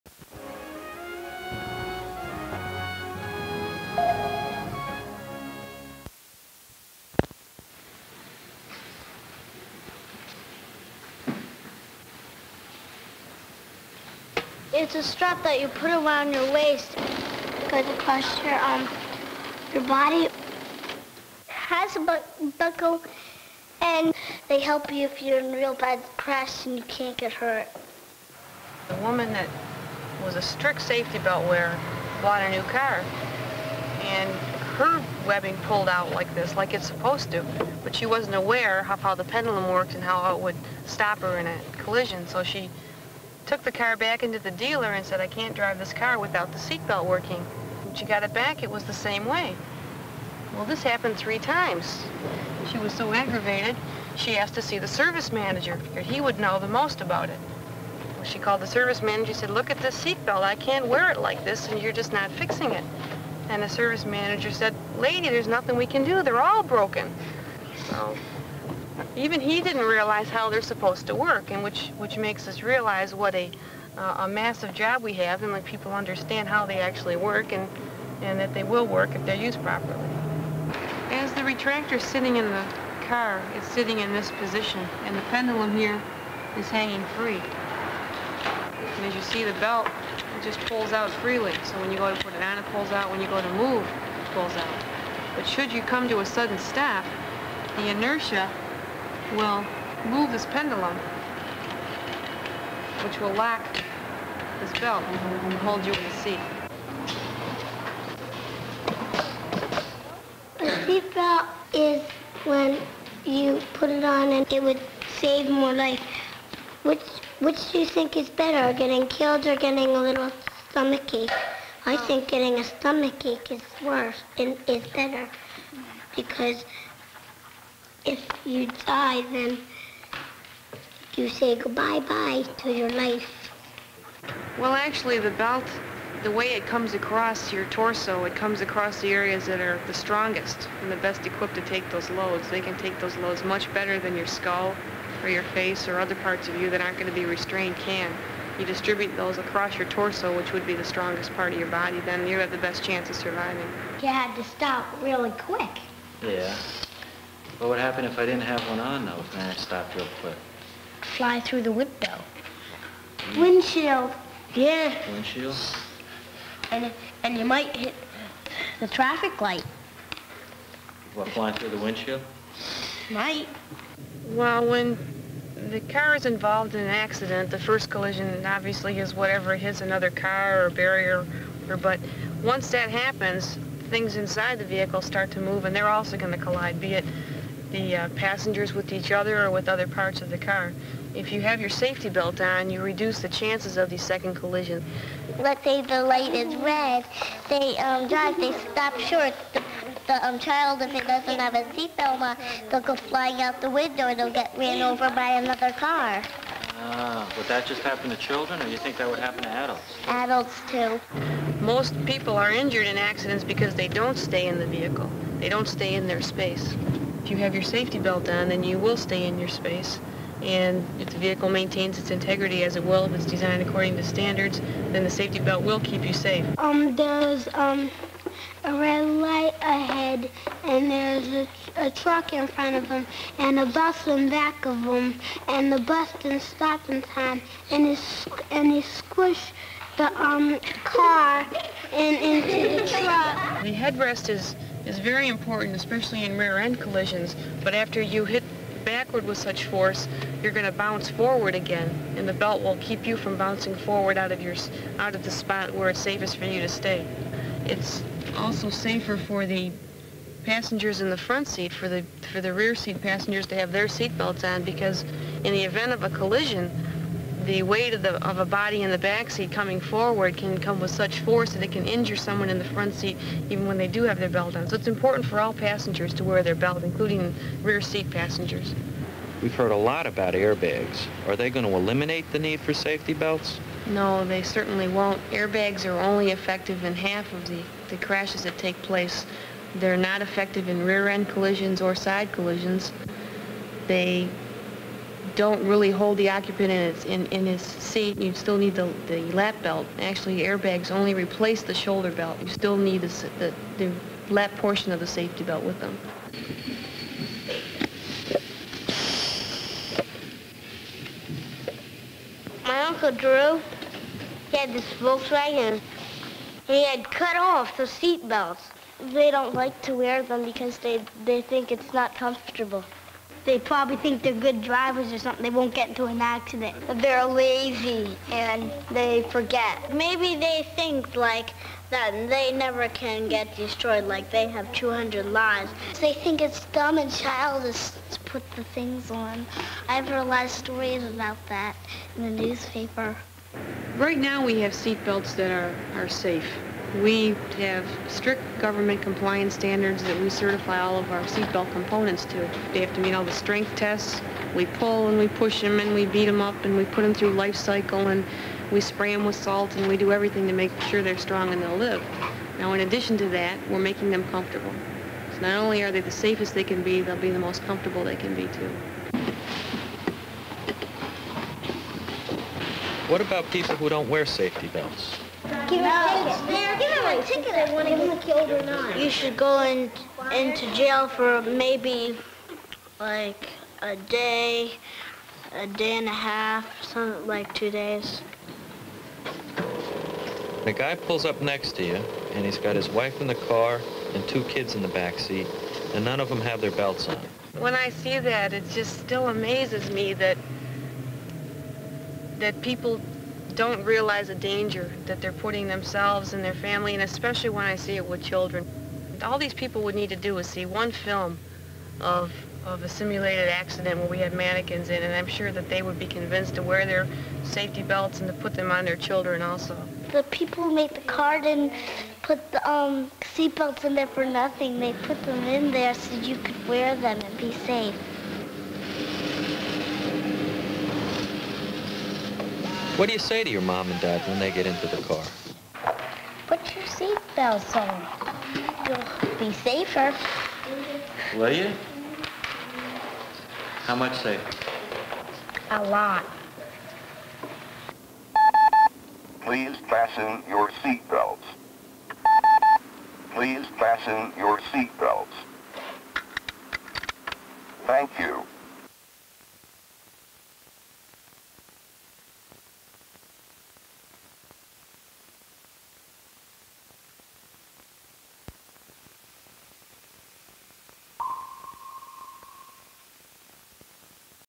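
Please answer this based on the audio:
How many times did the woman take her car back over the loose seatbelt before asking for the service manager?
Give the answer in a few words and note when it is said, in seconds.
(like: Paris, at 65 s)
3, at 51 s.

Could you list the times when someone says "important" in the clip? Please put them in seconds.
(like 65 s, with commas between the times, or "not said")
245 s, 274 s.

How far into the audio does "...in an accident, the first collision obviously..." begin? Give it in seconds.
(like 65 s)
176 s.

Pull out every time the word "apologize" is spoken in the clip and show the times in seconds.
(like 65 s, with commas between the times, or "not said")
not said.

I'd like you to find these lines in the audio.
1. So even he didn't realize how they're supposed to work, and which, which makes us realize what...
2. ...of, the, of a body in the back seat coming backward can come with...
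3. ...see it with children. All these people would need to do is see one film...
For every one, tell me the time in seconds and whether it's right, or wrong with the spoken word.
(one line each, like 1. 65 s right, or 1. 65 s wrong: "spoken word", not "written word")
1. 67 s right
2. 267 s wrong: "forward", not "backward"
3. 407 s right.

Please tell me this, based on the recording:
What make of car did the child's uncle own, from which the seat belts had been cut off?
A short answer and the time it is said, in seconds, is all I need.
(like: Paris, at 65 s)
Volkswagen, at 314 s.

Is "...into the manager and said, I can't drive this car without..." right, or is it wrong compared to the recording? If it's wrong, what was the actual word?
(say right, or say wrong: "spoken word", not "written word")
wrong: "dealer", not "manager".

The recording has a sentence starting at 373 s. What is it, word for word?
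What about people who don't wear safety belts?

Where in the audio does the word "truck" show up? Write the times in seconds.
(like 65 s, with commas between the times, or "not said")
231 s, 242 s.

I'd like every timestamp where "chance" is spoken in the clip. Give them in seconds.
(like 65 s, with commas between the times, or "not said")
152 s, 193 s.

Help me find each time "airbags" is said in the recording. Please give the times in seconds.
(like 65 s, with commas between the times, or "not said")
280 s, 285 s, 300 s.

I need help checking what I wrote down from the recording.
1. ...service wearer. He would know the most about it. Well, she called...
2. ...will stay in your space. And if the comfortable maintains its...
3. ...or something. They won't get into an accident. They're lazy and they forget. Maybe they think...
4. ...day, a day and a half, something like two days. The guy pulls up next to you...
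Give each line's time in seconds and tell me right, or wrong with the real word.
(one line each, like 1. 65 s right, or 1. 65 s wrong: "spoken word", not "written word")
1. 54 s wrong: "manager", not "wearer"
2. 218 s wrong: "vehicle", not "comfortable"
3. 325 s right
4. 383 s right.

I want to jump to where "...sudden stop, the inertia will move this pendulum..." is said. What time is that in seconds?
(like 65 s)
96 s.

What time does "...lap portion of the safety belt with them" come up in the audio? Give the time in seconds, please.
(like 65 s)
304 s.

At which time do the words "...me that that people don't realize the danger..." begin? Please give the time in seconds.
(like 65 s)
399 s.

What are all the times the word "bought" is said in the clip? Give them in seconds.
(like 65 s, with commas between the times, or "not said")
32 s.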